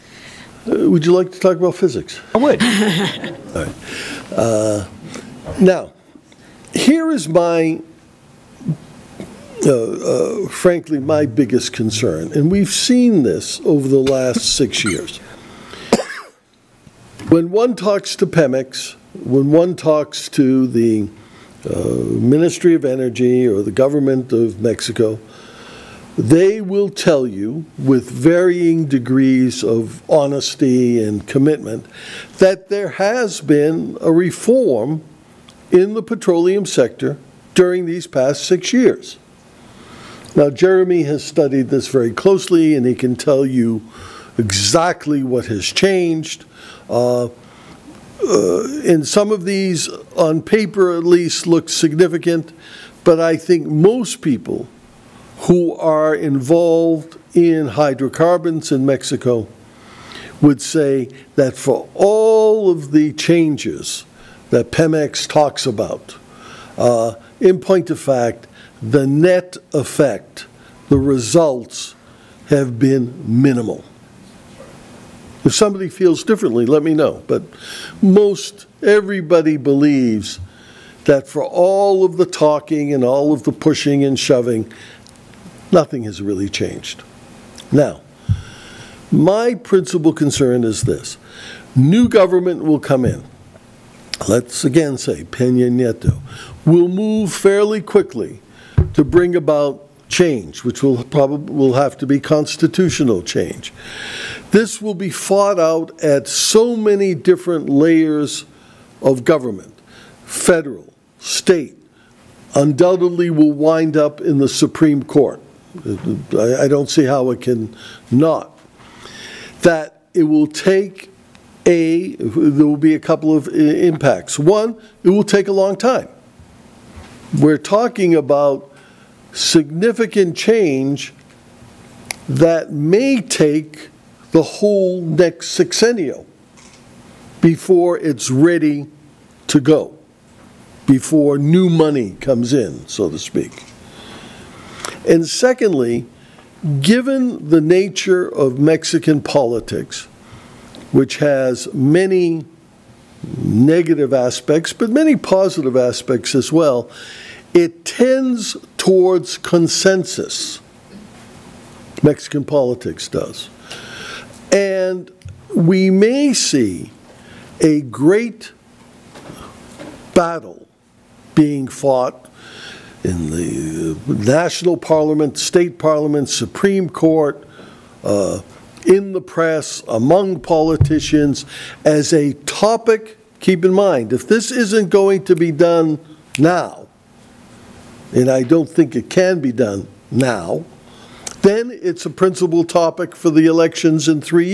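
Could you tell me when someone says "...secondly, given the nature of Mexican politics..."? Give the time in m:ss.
2:25.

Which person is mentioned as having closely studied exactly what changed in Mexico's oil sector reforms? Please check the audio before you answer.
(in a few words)
Jeremy.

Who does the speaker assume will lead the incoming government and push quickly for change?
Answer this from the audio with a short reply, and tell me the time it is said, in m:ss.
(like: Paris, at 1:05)
Peña Nieto, at 1:35.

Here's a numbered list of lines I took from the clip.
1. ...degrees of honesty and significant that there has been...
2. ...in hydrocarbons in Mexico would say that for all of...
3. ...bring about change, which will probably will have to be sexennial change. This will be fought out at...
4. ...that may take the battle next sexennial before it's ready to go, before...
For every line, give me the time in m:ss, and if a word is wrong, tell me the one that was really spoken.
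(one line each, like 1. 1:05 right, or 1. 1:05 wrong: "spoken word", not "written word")
1. 0:28 wrong: "commitment", not "significant"
2. 0:57 right
3. 1:39 wrong: "constitutional", not "sexennial"
4. 2:12 wrong: "whole", not "battle".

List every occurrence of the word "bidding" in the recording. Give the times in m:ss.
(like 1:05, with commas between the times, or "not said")
not said.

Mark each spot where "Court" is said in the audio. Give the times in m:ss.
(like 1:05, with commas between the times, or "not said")
1:55, 2:56.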